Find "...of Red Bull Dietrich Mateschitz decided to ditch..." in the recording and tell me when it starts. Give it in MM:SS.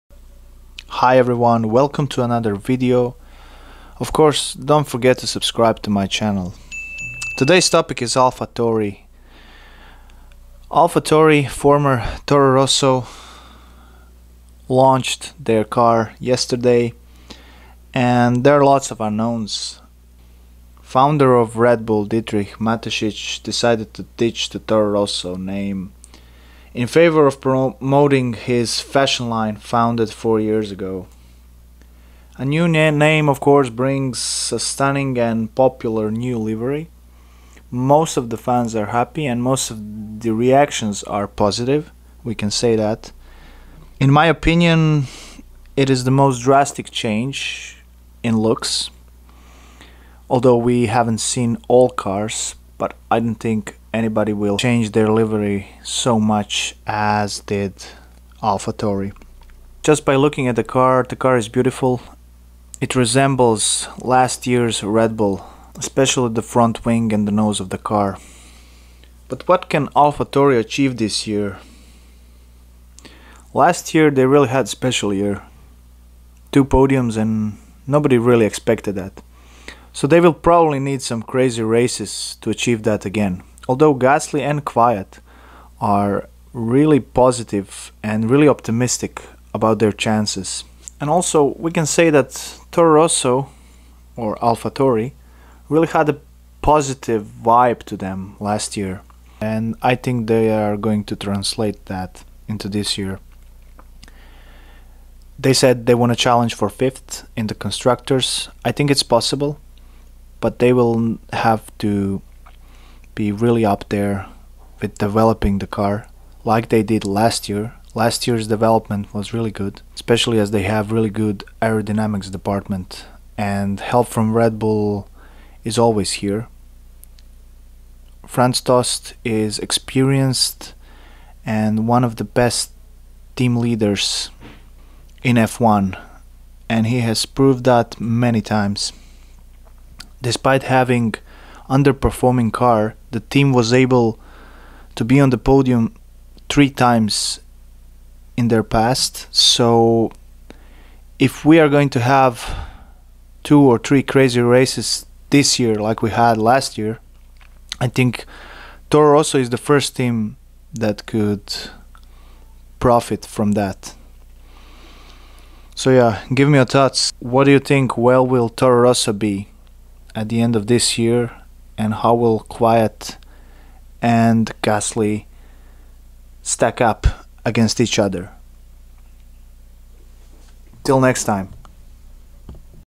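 00:21.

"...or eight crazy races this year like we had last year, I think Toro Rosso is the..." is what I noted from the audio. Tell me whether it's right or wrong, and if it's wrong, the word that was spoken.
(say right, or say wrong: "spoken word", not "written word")
wrong: "three", not "eight".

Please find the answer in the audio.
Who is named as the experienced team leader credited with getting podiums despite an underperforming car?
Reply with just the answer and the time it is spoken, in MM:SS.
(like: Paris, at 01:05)
Franz Tost, at 02:08.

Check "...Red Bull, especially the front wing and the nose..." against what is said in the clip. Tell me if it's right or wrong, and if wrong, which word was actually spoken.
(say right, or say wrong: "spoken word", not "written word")
right.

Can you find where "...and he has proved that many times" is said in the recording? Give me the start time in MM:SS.
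02:16.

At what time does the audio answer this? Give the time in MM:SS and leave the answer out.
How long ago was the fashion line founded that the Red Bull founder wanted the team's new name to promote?
00:30.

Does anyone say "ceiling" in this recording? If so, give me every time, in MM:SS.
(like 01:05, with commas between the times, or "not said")
not said.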